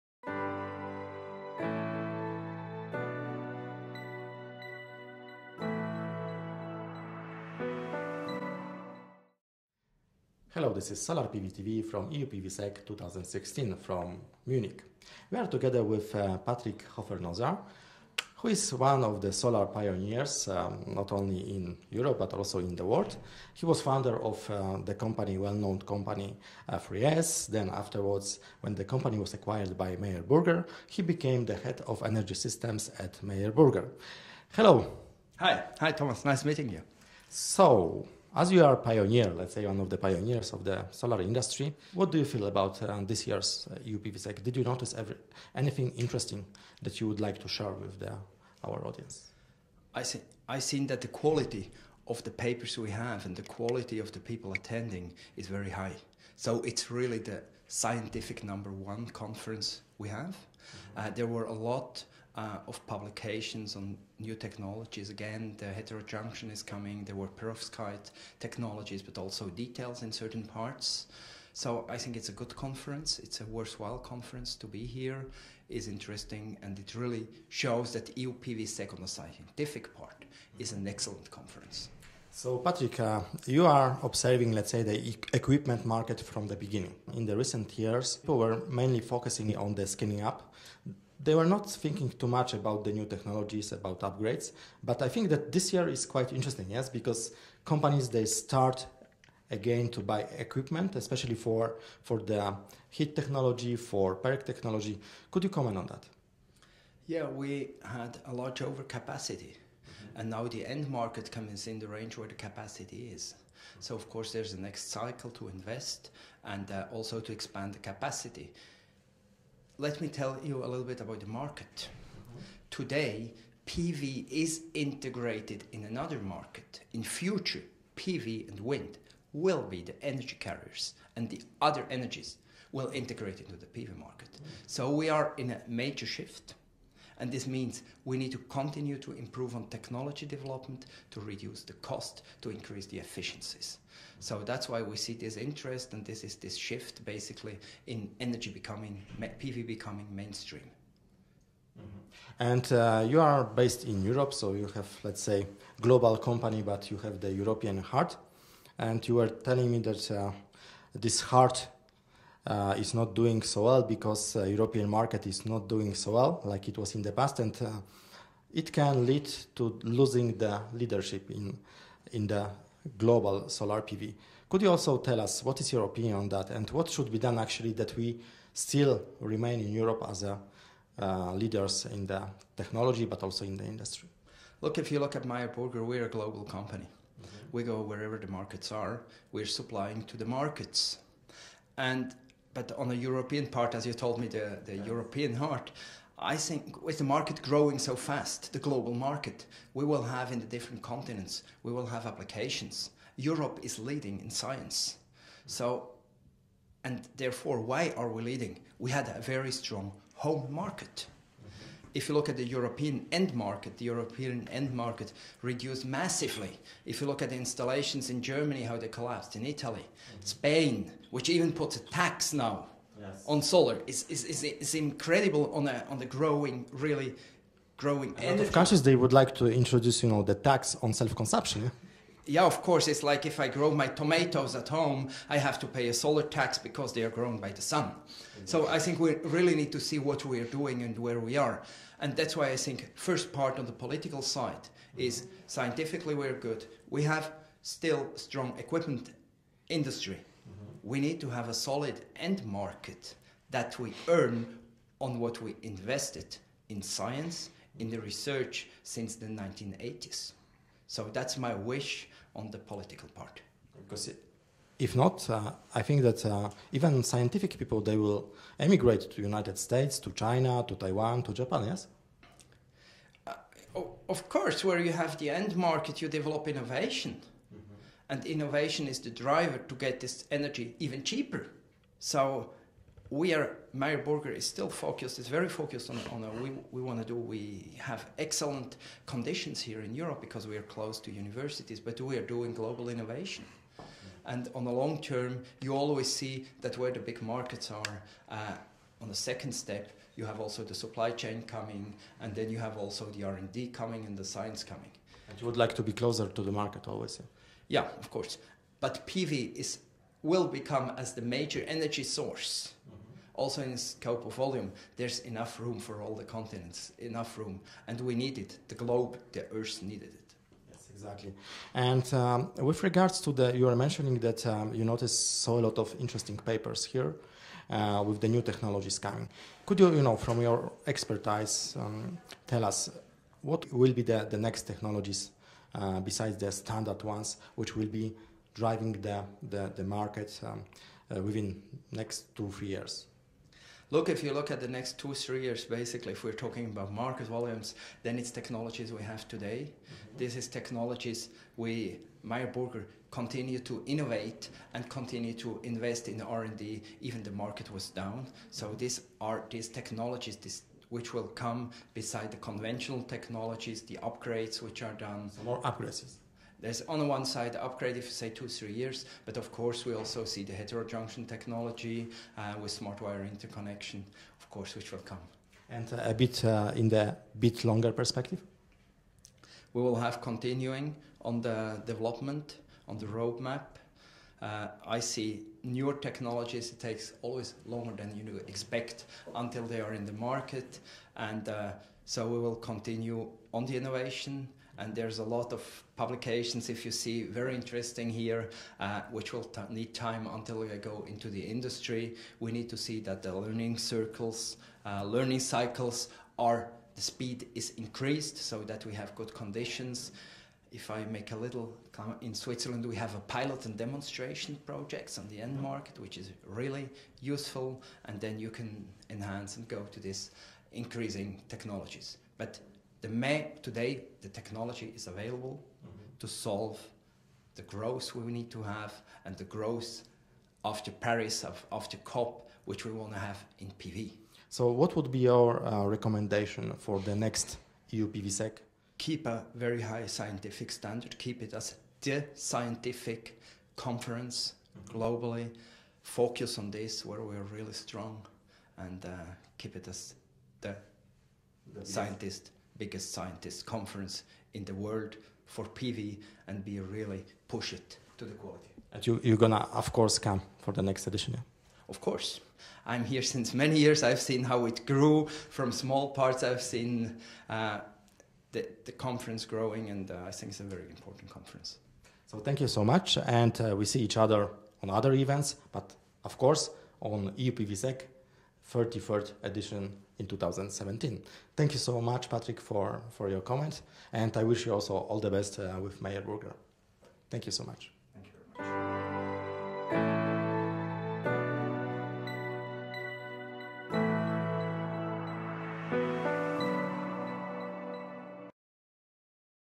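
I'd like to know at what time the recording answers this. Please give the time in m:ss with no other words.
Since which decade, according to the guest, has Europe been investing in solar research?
4:19.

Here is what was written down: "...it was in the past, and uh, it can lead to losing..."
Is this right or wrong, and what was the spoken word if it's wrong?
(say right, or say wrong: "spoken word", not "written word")
right.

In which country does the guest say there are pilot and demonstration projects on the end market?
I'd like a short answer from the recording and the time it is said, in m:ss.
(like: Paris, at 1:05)
Switzerland, at 6:52.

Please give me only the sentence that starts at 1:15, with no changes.
is interesting, and it really shows that EUPVSEC on the scientific part is an excellent conference.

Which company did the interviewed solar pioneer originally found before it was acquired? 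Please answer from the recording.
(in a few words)
3S.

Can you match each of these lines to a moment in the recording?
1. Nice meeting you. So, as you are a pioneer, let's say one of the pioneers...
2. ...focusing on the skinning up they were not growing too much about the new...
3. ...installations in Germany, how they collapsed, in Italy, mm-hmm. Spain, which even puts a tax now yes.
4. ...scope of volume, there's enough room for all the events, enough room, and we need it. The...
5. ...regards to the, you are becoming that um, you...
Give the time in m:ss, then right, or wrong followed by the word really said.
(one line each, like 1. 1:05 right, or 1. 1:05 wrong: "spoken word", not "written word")
1. 0:36 right
2. 1:28 wrong: "thinking", not "growing"
3. 3:37 right
4. 5:13 wrong: "continents", not "events"
5. 5:22 wrong: "mentioning", not "becoming".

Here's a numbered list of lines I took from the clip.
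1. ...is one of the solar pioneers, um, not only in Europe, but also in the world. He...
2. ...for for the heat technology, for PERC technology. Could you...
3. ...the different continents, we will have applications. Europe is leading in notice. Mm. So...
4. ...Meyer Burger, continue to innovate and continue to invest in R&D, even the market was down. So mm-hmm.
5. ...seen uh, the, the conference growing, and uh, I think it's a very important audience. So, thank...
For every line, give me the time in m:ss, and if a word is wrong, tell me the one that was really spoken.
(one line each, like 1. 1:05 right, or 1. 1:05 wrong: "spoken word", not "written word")
1. 0:18 right
2. 1:41 right
3. 3:20 wrong: "science", not "notice"
4. 5:52 right
5. 7:46 wrong: "conference", not "audience".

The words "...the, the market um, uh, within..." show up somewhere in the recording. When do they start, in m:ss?
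5:39.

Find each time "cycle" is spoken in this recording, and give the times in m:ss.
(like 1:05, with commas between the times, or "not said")
1:54, 6:45.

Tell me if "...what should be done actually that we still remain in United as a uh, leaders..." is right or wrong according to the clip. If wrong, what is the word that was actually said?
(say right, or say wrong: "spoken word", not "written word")
wrong: "Europe", not "United".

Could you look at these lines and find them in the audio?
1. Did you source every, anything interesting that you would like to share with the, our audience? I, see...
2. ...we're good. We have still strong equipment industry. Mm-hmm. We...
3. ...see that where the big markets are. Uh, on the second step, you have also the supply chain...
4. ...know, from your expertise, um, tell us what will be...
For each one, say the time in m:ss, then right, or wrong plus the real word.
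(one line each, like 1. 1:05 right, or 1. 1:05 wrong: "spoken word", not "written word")
1. 0:44 wrong: "notice", not "source"
2. 4:06 right
3. 4:56 right
4. 5:30 right.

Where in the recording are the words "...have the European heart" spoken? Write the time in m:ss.
2:37.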